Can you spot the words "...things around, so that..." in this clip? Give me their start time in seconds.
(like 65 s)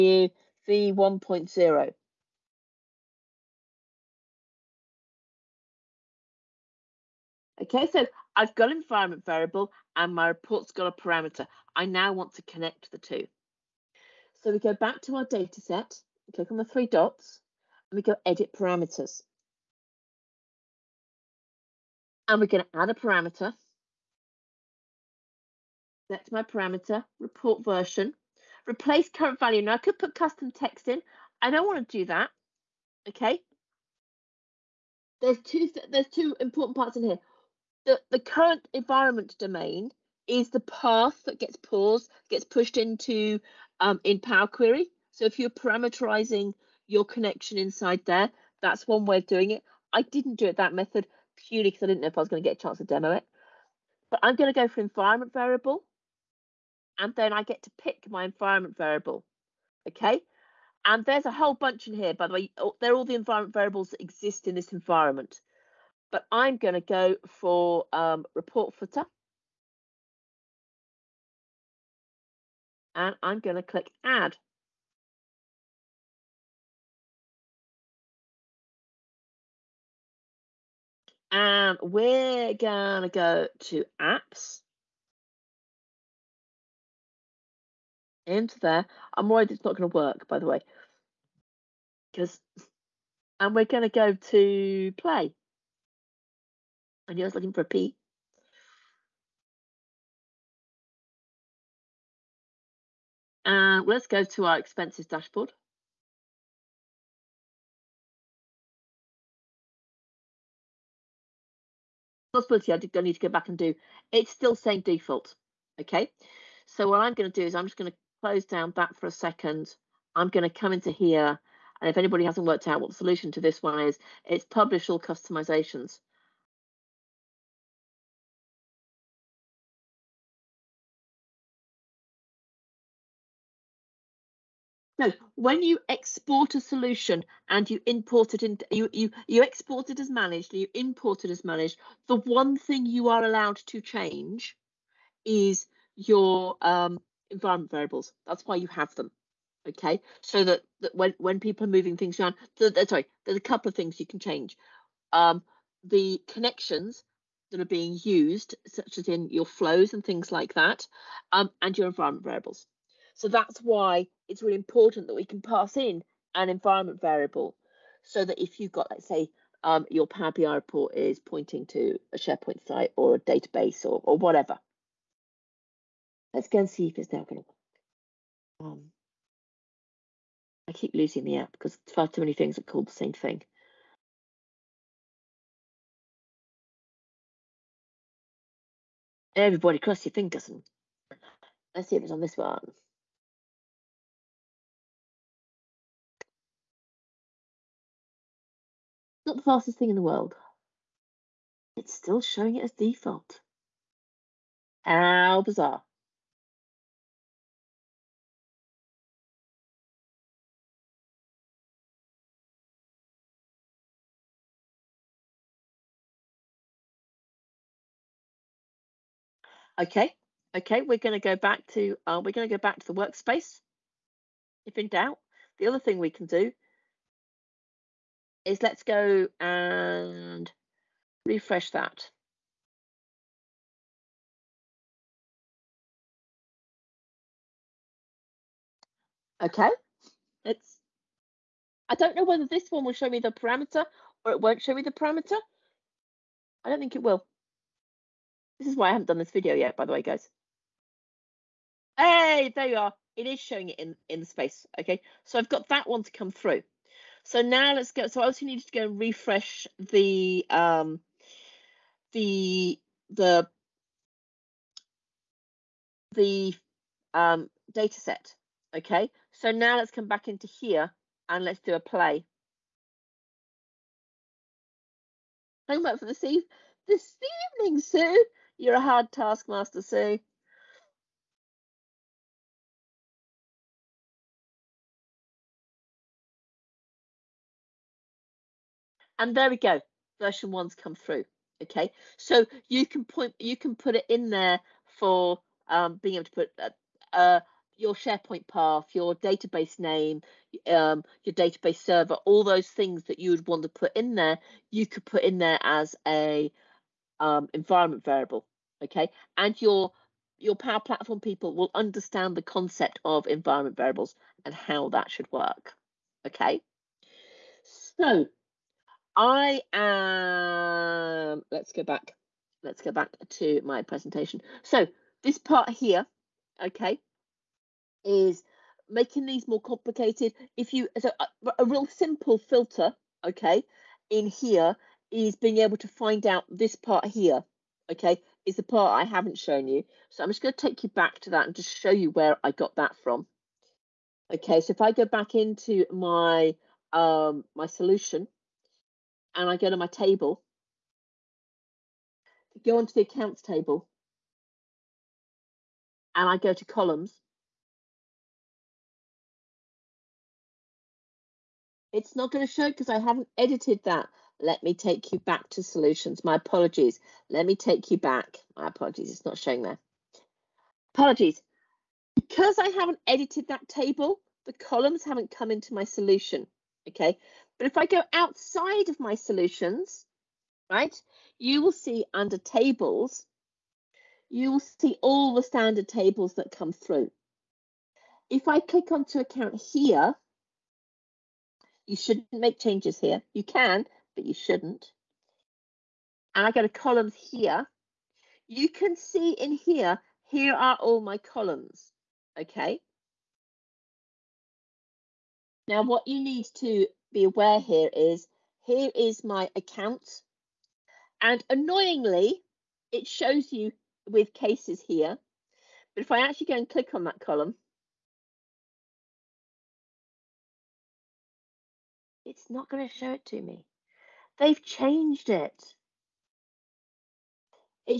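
151 s.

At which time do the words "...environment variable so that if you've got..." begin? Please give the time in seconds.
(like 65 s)
166 s.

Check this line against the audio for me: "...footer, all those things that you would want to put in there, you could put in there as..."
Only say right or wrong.
wrong.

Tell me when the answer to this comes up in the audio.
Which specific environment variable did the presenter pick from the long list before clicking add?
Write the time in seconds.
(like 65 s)
68 s.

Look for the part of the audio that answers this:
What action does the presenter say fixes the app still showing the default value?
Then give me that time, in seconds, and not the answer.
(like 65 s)
124 s.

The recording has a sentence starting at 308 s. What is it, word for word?
Okay, and your your Power Platform people will understand the concept of environment variables and how that should work.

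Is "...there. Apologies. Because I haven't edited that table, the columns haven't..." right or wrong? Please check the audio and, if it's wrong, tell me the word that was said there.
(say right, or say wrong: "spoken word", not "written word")
right.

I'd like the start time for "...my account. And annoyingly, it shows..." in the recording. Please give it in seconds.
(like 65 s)
409 s.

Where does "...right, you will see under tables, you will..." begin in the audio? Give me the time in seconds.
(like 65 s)
380 s.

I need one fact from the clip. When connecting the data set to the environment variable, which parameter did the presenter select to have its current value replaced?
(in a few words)
Report version.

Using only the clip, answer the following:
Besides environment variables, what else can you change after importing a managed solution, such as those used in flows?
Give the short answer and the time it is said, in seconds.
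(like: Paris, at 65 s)
The connections, at 156 s.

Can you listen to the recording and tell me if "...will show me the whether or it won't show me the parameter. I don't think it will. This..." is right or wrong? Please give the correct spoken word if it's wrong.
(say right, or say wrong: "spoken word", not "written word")
wrong: "parameter", not "whether".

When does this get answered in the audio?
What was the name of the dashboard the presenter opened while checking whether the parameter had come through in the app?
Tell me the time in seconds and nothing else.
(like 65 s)
104 s.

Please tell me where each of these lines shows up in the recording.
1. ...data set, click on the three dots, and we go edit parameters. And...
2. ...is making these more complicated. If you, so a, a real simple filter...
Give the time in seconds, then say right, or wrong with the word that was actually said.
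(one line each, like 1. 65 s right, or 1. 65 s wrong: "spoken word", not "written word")
1. 15 s right
2. 328 s right.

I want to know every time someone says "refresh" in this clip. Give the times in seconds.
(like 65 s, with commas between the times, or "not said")
231 s, 258 s.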